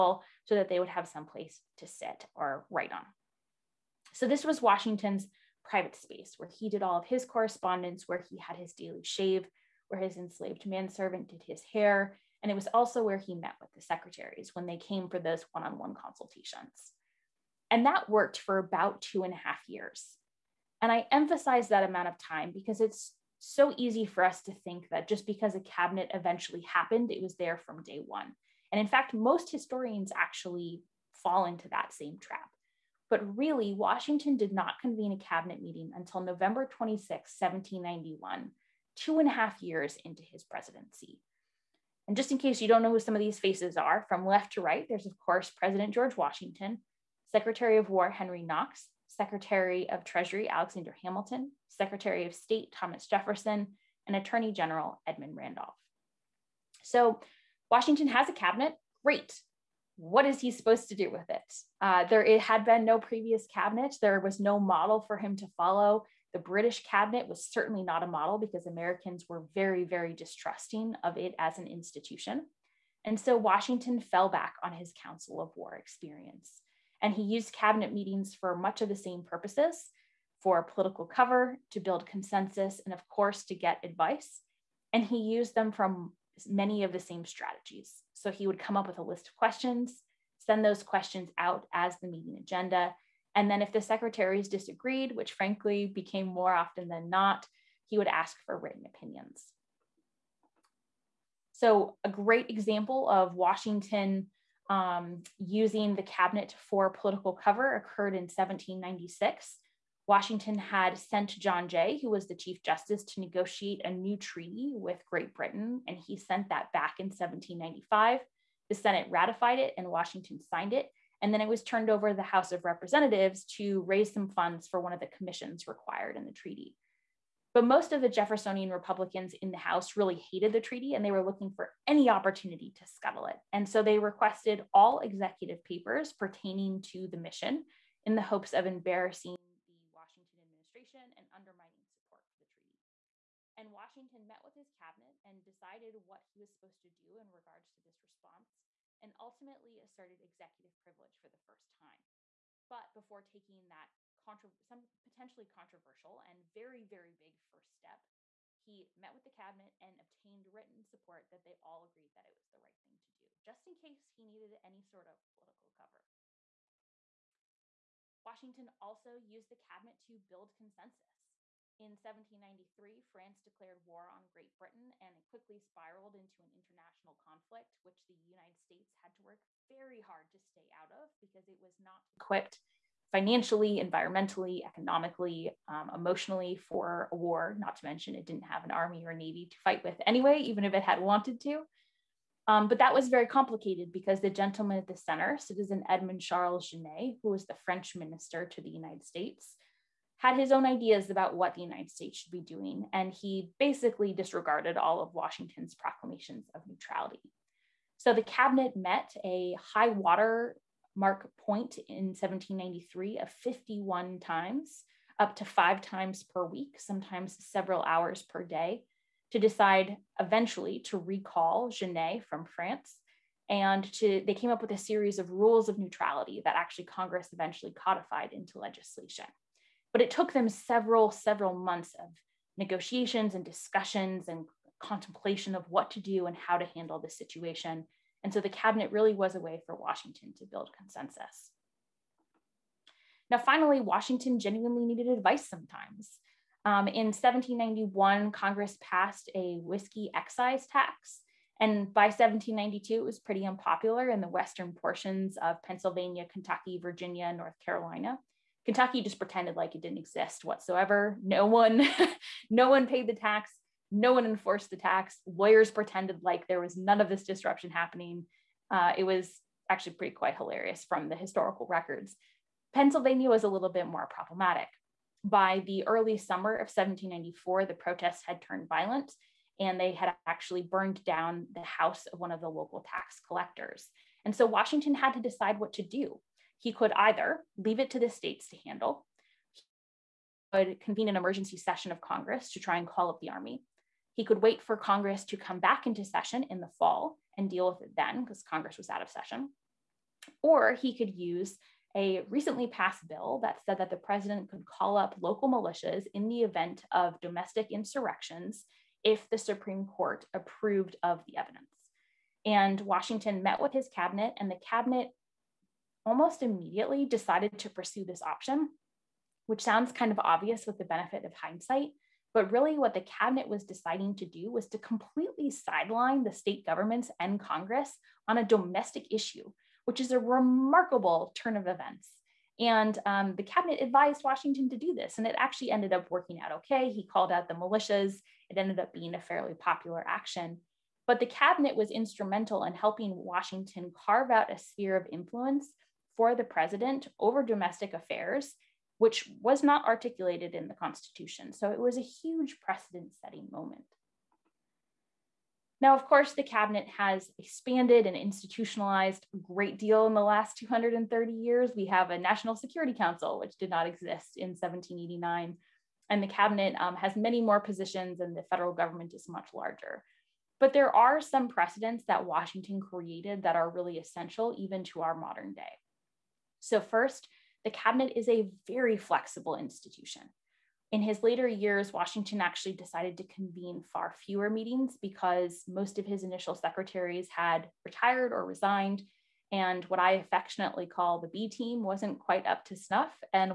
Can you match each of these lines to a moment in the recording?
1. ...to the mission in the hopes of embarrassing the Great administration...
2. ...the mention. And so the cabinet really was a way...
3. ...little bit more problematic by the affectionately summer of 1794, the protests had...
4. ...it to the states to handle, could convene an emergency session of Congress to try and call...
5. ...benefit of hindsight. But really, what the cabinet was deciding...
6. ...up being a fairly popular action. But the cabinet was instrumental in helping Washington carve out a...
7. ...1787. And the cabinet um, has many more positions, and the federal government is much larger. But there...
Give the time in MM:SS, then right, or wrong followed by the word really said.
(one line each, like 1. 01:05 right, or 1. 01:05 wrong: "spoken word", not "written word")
1. 02:16 wrong: "Washington", not "Great"
2. 03:56 wrong: "situation", not "mention"
3. 04:33 wrong: "early", not "affectionately"
4. 04:47 right
5. 05:20 right
6. 05:38 right
7. 06:04 wrong: "1789", not "1787".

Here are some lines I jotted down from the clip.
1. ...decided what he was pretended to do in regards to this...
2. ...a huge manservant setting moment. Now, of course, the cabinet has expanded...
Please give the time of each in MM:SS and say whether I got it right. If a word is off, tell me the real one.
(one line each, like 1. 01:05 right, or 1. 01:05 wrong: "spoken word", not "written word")
1. 02:25 wrong: "supposed", not "pretended"
2. 05:51 wrong: "precedent", not "manservant".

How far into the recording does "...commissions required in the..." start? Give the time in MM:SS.
02:05.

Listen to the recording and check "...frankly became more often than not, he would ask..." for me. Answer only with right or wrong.
right.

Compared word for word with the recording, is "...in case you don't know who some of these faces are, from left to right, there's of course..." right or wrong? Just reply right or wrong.
right.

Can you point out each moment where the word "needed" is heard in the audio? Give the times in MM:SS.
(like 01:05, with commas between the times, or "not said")
02:44, 04:04.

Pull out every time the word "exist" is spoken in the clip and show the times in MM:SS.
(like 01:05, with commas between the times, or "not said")
04:19, 06:03.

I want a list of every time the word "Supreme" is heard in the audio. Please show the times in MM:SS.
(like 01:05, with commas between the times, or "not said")
05:09.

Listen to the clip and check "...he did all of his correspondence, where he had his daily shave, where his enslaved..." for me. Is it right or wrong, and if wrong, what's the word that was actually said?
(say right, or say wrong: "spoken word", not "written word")
right.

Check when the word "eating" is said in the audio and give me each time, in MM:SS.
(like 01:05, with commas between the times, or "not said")
not said.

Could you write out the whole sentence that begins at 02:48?
Washington also used the cabinet to build consensus.